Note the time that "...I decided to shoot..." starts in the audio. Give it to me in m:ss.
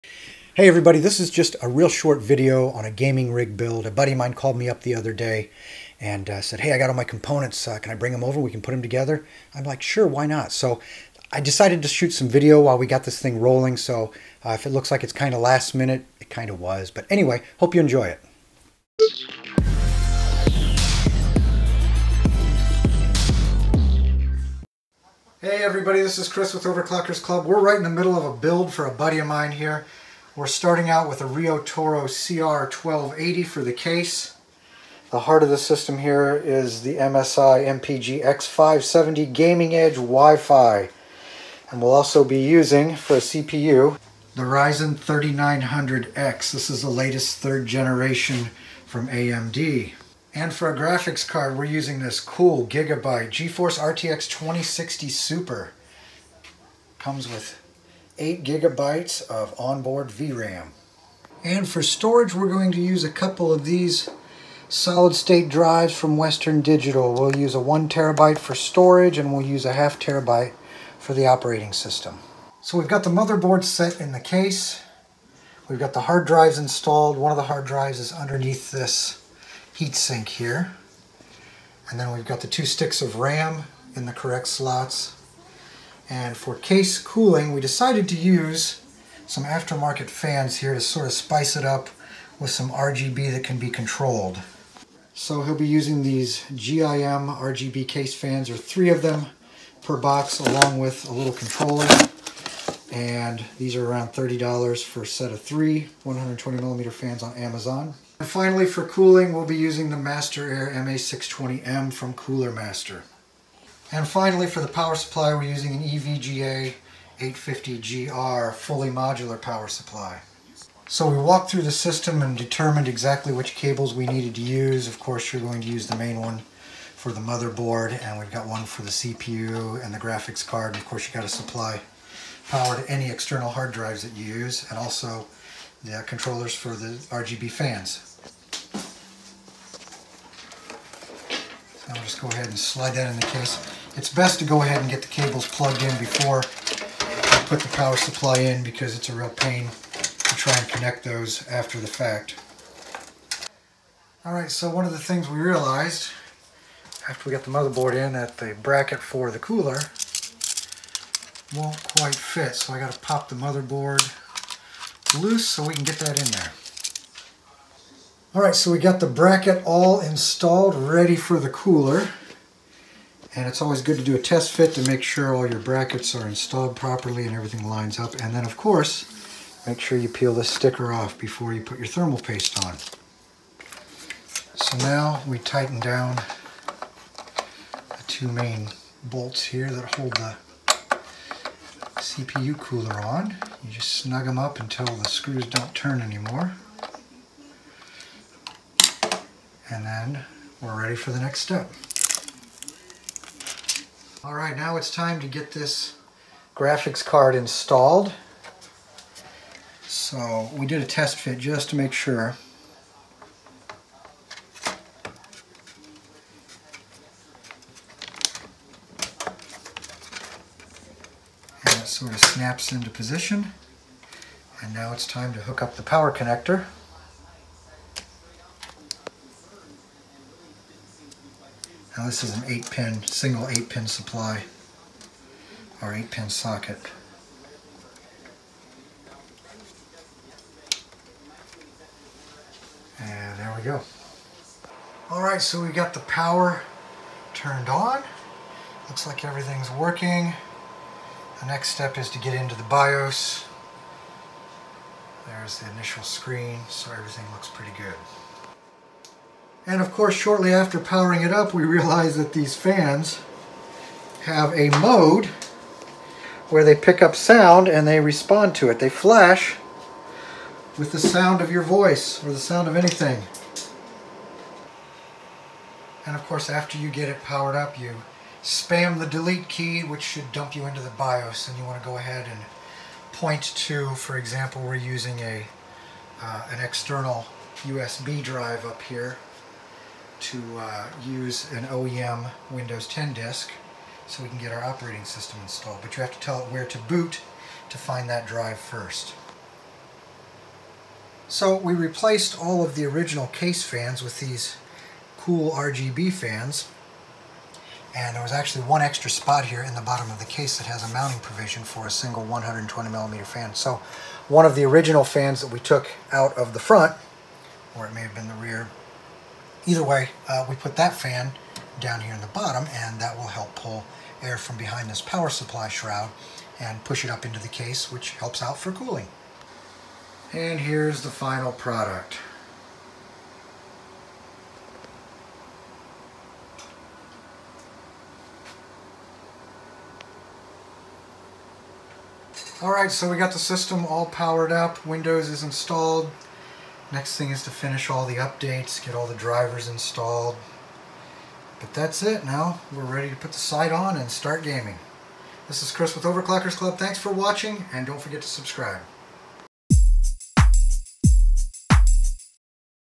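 0:11.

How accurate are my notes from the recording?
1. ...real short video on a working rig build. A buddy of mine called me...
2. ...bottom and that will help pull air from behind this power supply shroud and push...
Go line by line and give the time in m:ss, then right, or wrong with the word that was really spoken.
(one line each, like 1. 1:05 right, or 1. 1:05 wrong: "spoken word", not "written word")
1. 0:01 wrong: "gaming", not "working"
2. 5:22 right.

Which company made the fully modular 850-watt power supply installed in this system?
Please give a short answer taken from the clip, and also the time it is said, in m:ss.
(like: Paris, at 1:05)
EVGA, at 1:55.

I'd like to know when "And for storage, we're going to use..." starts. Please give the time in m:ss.
1:01.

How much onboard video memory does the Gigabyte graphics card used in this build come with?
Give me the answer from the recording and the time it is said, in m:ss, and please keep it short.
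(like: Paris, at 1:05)
8 gigabytes, at 0:58.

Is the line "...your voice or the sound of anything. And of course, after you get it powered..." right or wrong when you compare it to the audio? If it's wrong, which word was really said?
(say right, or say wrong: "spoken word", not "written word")
right.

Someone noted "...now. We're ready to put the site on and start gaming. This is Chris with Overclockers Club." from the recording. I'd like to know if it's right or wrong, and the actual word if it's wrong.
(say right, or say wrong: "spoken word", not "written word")
right.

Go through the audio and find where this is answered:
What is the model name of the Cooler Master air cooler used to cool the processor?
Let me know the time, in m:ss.
1:49.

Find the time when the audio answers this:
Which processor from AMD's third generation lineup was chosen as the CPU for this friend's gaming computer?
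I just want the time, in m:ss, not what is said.
0:44.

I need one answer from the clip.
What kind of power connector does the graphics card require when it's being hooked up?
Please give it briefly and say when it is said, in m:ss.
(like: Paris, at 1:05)
single 8-pin, at 3:53.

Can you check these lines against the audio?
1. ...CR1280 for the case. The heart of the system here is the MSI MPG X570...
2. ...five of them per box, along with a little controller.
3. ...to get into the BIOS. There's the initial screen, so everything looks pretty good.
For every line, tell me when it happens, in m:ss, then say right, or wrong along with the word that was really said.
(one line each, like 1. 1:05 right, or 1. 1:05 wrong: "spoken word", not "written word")
1. 0:32 right
2. 1:38 wrong: "three", not "five"
3. 4:12 right.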